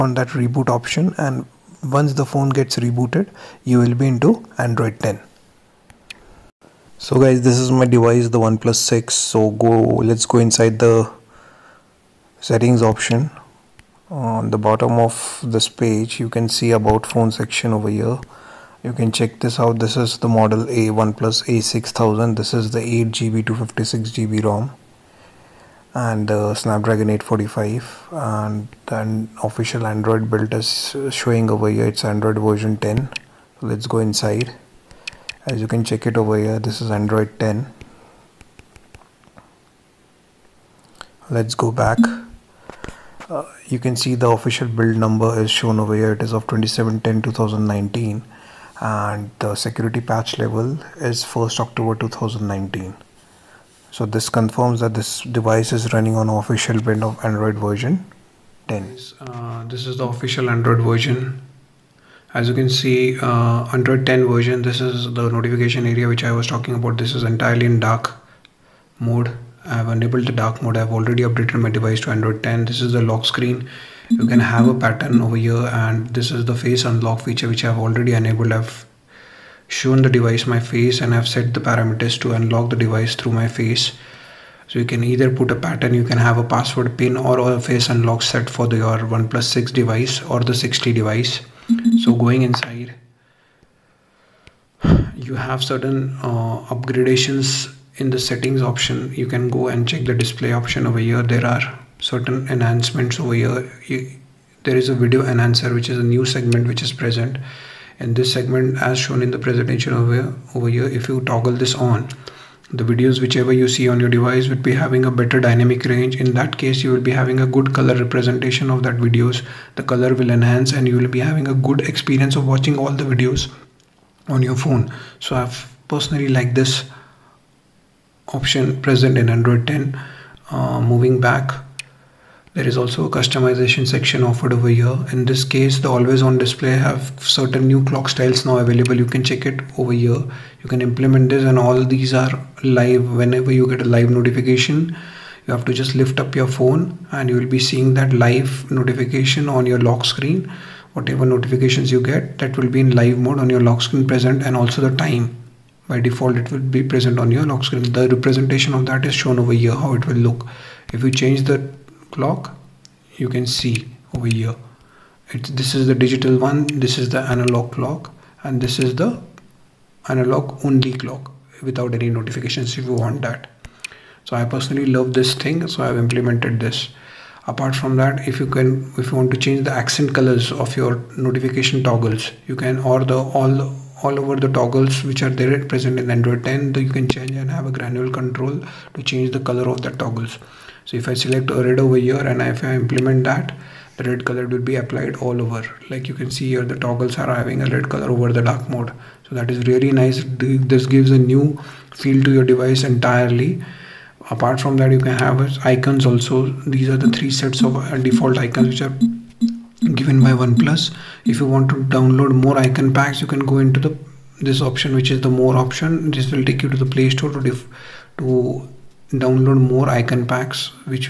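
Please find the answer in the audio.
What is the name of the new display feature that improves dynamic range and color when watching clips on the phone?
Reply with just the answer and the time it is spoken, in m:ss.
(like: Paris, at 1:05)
video enhancer, at 1:44.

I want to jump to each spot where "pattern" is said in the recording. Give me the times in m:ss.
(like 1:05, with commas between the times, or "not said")
1:14, 1:25.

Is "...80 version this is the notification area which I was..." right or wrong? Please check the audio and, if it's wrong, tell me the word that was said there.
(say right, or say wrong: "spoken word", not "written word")
wrong: "10", not "80".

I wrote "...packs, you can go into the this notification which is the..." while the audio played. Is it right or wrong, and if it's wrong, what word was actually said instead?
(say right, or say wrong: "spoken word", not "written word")
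wrong: "option", not "notification".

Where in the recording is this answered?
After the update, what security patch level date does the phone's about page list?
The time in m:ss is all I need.
0:51.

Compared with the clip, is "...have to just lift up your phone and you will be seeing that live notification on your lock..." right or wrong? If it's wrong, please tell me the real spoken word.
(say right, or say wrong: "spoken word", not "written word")
right.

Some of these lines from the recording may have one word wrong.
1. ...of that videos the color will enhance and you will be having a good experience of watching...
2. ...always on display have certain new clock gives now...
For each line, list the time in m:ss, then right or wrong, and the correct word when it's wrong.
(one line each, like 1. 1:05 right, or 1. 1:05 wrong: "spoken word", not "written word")
1. 1:58 right
2. 2:15 wrong: "styles", not "gives".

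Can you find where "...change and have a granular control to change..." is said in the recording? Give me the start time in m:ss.
3:07.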